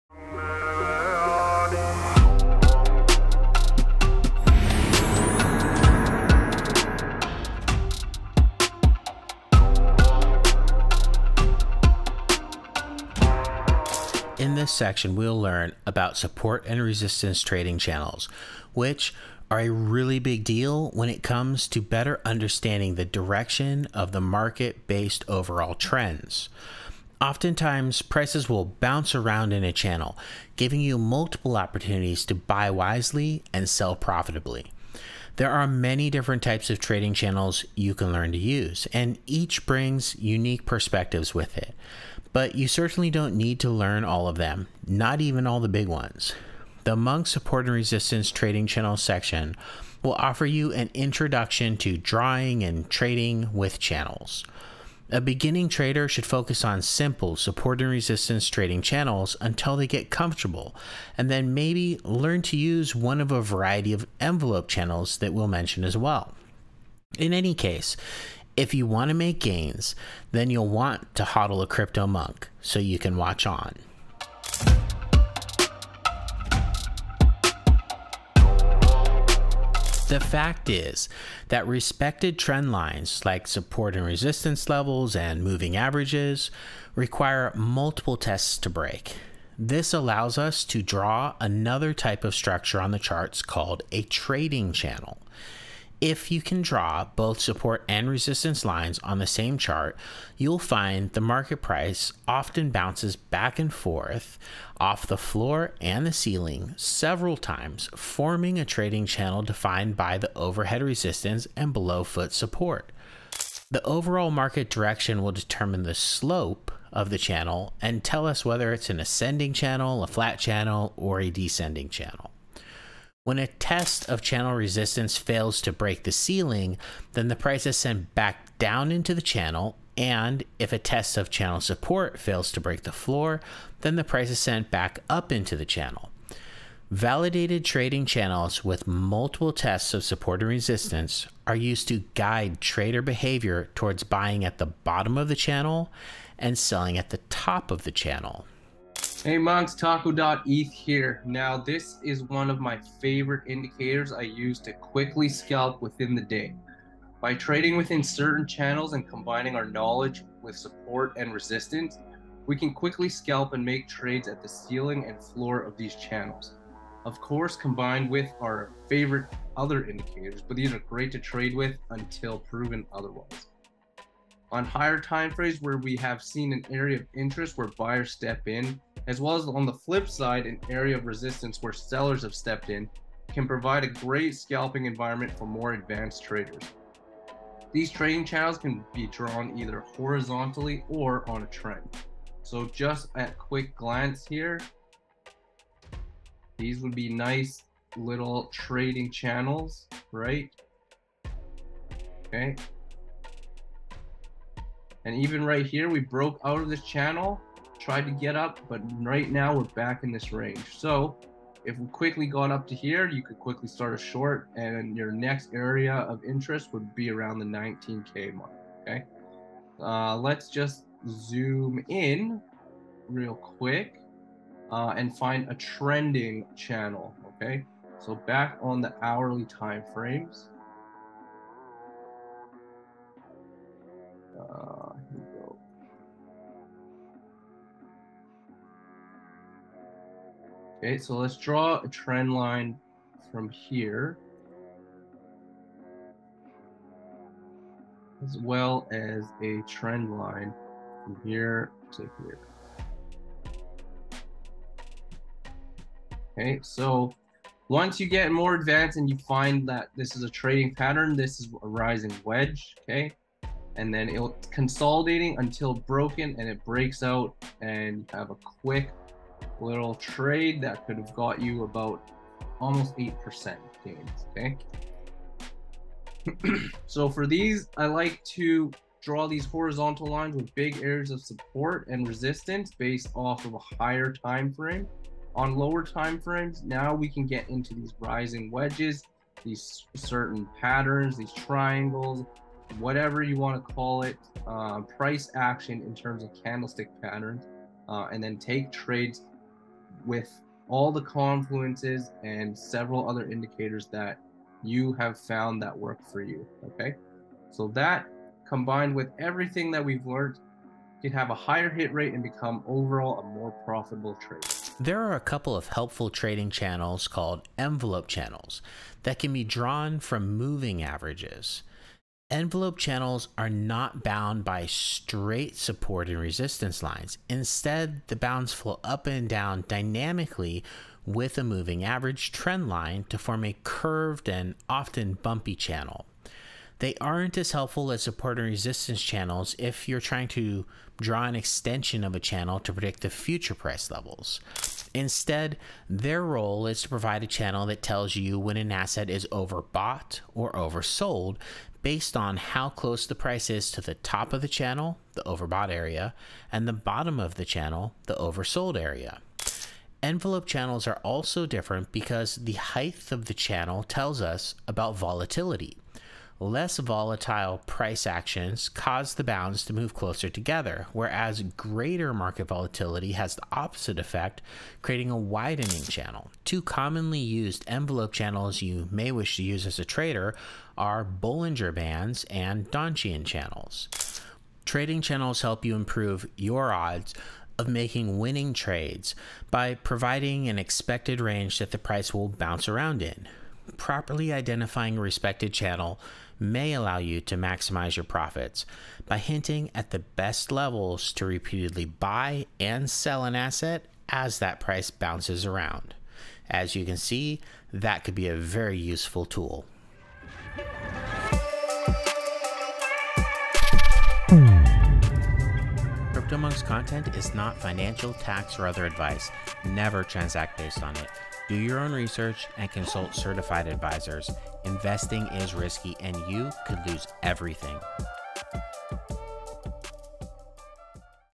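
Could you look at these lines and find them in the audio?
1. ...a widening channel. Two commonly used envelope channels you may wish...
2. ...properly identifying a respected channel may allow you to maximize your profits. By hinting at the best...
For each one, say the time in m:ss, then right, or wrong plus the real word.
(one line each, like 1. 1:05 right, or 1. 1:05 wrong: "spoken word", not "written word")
1. 6:15 right
2. 6:33 right.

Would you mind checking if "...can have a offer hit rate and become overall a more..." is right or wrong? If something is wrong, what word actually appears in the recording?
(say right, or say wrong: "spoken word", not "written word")
wrong: "higher", not "offer".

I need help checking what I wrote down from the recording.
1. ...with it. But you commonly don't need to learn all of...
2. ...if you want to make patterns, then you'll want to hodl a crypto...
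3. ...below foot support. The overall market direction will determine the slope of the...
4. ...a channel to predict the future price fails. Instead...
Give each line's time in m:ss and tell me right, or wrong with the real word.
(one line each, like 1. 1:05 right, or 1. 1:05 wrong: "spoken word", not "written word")
1. 0:41 wrong: "certainly", not "commonly"
2. 1:08 wrong: "gains", not "patterns"
3. 1:51 right
4. 5:42 wrong: "levels", not "fails".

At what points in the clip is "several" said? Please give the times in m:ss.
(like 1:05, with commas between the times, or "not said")
1:46, 5:02.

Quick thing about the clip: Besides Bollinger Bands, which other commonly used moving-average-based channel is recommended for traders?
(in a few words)
Donchian channels.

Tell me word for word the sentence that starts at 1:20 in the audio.
The fact is that respected trend lines like support and resistance levels and moving averages require multiple tests to break.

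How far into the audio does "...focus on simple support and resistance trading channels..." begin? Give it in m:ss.
0:56.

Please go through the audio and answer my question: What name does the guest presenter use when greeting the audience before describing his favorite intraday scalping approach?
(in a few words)
taco.eth.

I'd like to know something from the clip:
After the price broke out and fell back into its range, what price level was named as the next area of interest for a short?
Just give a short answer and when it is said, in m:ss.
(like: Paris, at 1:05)
19K, at 3:37.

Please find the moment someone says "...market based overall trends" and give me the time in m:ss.
0:24.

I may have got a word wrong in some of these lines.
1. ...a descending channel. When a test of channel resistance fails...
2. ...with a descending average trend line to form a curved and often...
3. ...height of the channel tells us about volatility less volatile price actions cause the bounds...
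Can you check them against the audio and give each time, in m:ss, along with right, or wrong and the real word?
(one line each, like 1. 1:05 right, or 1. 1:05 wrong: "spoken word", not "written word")
1. 2:01 right
2. 5:31 wrong: "moving", not "descending"
3. 6:02 right.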